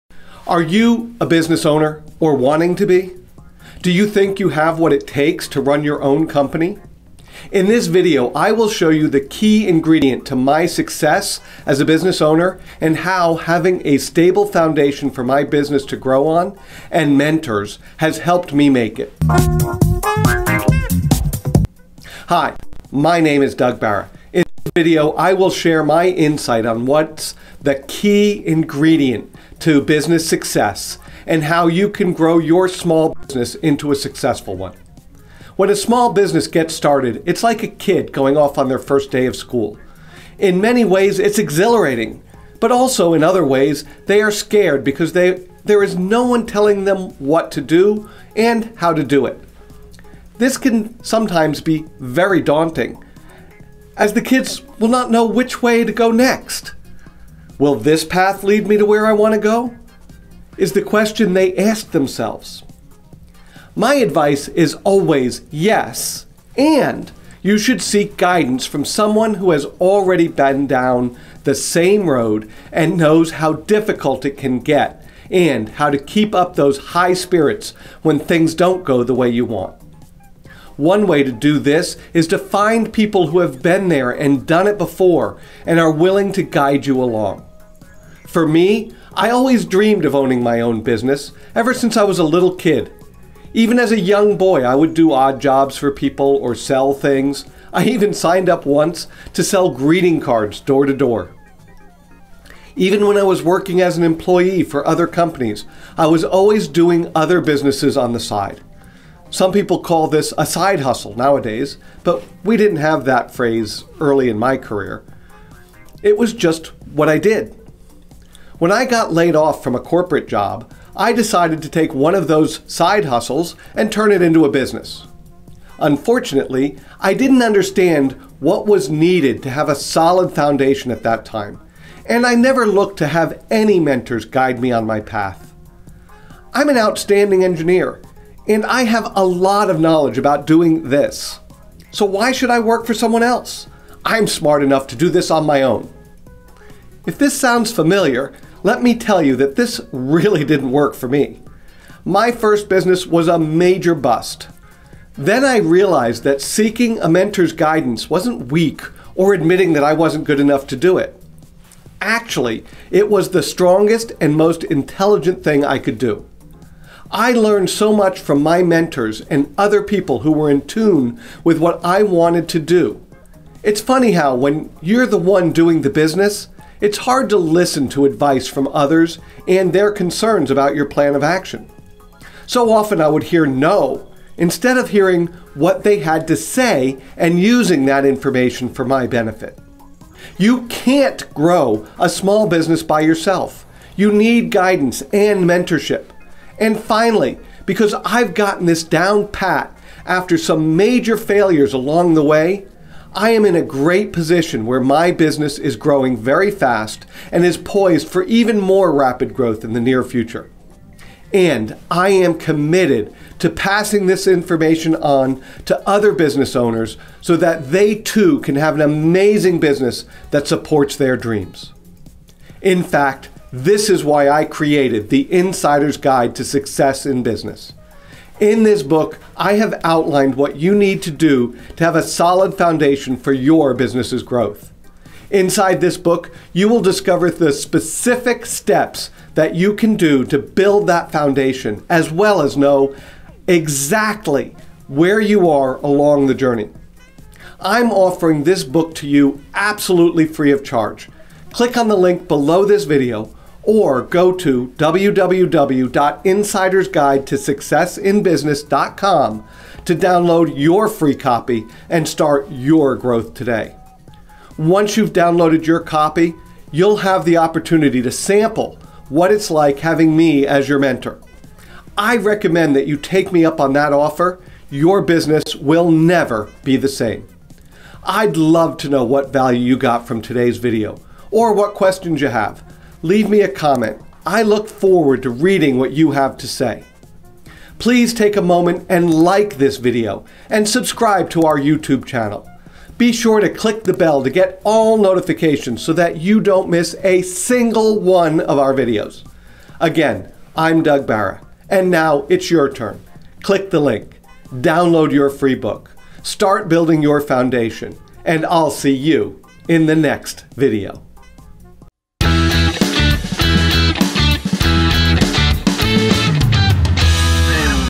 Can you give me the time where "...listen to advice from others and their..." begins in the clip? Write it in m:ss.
2:57.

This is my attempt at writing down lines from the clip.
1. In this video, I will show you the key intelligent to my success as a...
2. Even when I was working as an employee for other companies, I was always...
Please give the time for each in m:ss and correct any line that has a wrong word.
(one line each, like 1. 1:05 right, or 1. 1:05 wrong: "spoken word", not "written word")
1. 0:07 wrong: "ingredient", not "intelligent"
2. 1:42 right.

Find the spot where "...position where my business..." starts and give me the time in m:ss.
3:24.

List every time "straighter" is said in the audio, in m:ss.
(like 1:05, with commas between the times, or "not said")
not said.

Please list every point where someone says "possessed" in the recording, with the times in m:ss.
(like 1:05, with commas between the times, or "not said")
not said.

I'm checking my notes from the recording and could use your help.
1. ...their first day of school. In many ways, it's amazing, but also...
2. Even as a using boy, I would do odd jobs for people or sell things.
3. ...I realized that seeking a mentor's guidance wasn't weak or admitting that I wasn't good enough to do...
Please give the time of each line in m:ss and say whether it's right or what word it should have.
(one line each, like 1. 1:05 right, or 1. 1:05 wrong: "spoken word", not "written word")
1. 0:38 wrong: "exhilarating", not "amazing"
2. 1:33 wrong: "young", not "using"
3. 2:35 right.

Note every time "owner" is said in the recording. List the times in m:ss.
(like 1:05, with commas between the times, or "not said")
0:01, 0:12, 3:36.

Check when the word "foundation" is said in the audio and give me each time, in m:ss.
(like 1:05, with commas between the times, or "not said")
0:14, 2:10, 3:52, 4:01, 5:07.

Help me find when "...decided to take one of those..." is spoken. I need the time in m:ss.
2:01.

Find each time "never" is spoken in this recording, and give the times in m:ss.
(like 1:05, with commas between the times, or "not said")
2:12, 4:35.